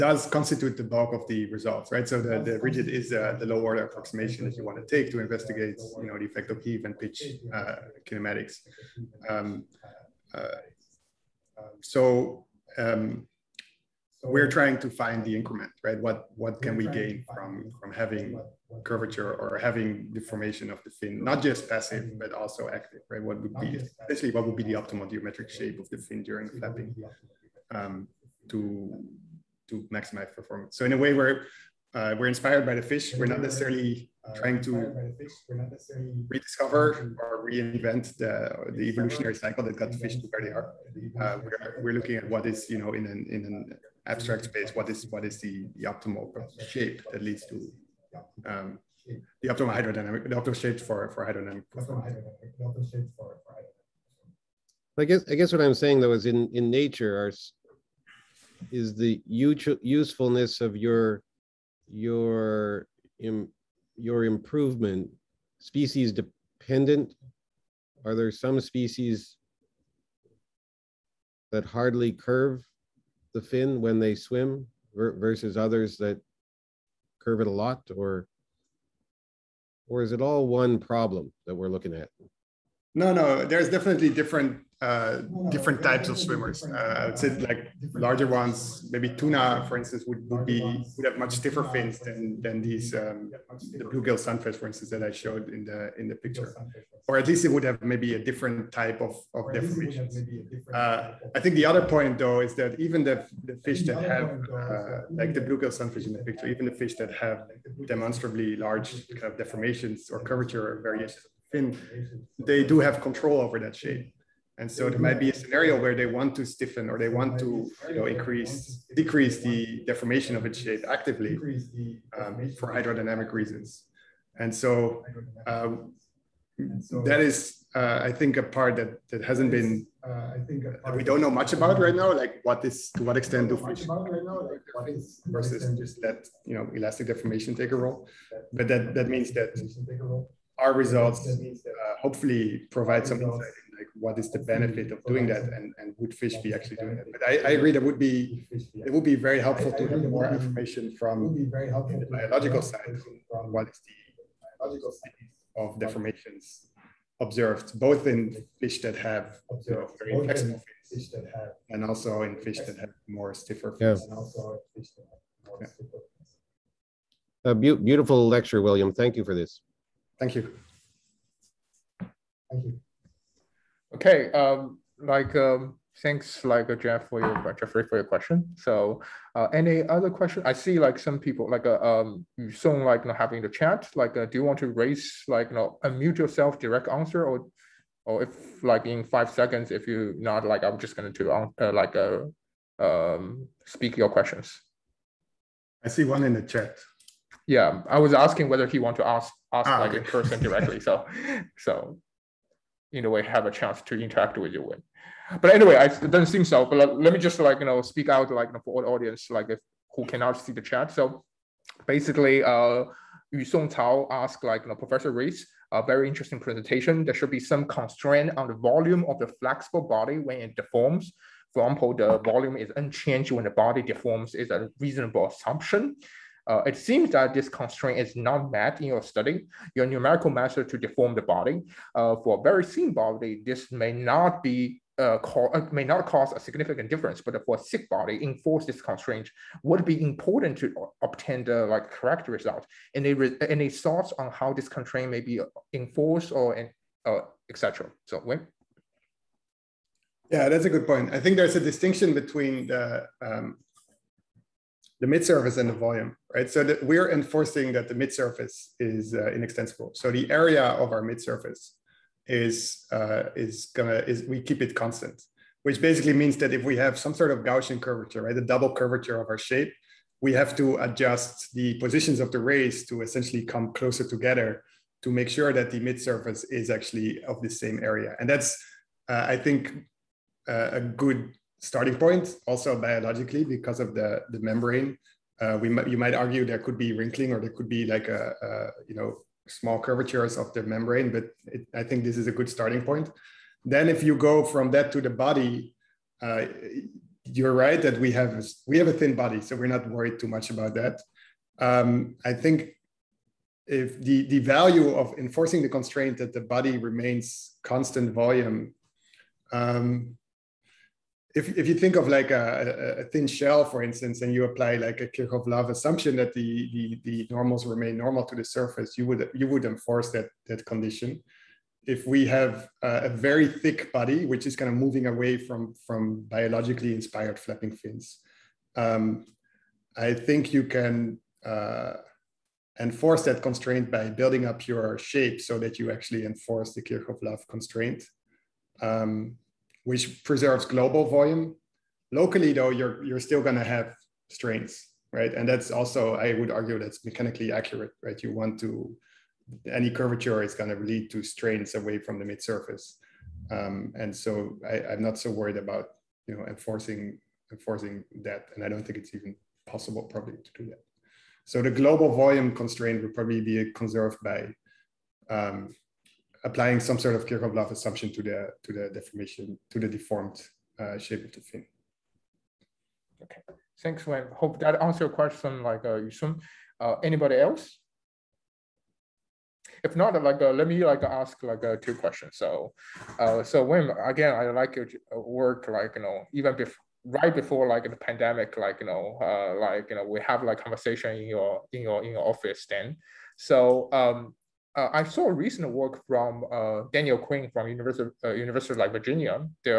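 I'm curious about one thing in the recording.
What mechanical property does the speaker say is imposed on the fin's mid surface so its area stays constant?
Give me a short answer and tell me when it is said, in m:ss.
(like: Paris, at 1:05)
Inextensible, at 4:19.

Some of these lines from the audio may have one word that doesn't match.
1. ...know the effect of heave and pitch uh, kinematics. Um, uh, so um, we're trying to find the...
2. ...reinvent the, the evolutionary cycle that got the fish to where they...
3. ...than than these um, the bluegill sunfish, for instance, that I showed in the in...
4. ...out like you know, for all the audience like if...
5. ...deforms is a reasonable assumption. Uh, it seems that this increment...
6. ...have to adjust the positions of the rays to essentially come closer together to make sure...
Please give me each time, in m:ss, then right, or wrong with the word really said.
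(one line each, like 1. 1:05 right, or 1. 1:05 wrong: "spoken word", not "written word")
1. 0:06 right
2. 0:37 right
3. 1:31 right
4. 3:28 right
5. 3:43 wrong: "constraint", not "increment"
6. 4:30 right.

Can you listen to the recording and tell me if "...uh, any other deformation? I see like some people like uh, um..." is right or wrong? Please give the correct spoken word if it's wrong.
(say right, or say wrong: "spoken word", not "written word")
wrong: "question", not "deformation".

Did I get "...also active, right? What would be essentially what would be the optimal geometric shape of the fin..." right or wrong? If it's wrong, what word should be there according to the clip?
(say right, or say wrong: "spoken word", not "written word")
right.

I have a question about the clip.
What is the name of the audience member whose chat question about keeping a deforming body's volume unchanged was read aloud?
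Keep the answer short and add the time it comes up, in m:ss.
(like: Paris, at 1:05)
Yu Song Cao, at 3:33.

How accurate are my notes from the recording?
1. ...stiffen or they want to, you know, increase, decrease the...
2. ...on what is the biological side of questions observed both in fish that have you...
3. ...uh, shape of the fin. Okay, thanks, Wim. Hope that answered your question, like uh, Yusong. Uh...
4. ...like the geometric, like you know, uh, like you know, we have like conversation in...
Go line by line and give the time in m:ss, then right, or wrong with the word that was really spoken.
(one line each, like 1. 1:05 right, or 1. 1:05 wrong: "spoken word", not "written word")
1. 1:56 right
2. 2:33 wrong: "deformations", not "questions"
3. 6:10 right
4. 6:27 wrong: "pandemic", not "geometric".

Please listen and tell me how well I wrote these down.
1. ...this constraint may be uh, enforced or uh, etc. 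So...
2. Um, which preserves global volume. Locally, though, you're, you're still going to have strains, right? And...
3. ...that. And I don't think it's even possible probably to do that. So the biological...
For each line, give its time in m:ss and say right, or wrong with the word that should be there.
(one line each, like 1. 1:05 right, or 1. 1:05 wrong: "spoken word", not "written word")
1. 4:04 right
2. 5:38 right
3. 5:58 wrong: "global", not "biological".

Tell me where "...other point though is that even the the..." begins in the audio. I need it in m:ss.
1:41.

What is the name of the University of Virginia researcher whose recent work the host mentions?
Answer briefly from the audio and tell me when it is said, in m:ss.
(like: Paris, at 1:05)
Daniel Quinn, at 6:36.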